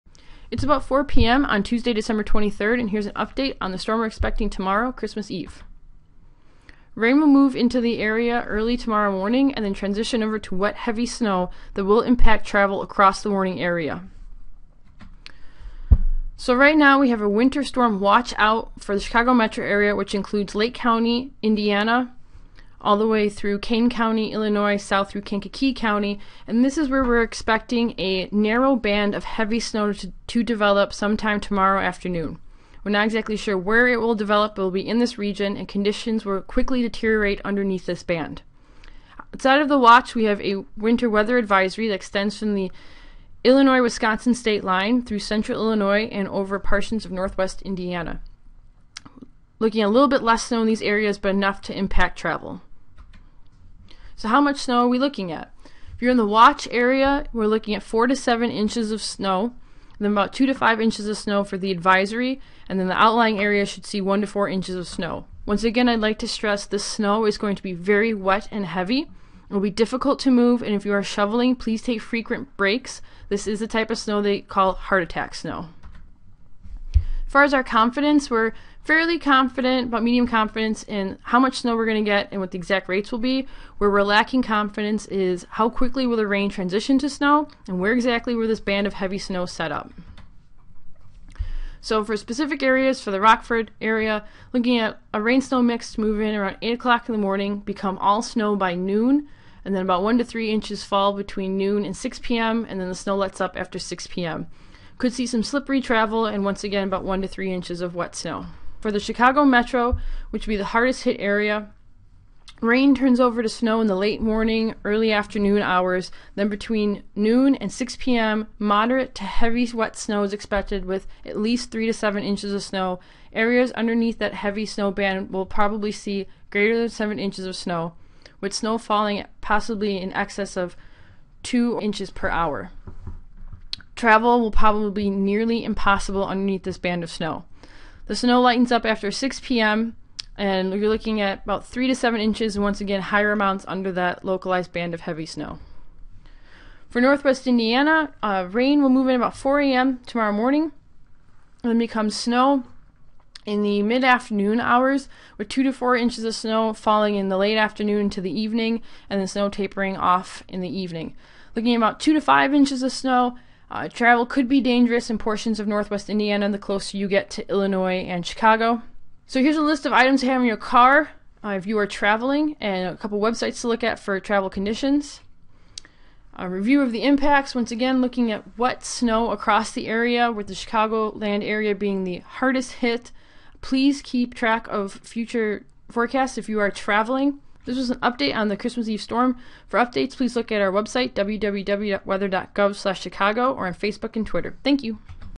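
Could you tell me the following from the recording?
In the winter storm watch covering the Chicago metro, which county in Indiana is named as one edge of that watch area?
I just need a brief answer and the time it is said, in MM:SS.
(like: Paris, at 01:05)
Lake County, at 00:20.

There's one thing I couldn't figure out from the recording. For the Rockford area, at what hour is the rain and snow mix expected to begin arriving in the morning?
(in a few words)
8 o'clock.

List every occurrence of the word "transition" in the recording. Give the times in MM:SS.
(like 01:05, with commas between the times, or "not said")
00:09, 01:26.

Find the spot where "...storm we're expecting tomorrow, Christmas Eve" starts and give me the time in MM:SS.
00:03.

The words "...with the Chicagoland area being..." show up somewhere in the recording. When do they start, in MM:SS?
03:00.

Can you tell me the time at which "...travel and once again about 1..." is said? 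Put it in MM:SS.
01:45.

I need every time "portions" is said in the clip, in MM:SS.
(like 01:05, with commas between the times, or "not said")
00:46, 02:45.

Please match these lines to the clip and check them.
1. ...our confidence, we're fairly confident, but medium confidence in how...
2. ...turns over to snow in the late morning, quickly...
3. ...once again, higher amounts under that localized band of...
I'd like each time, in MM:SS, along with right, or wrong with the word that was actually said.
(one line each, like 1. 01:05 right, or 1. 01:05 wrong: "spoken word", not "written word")
1. 01:17 right
2. 01:52 wrong: "early", not "quickly"
3. 02:22 right.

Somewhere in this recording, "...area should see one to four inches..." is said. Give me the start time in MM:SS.
01:03.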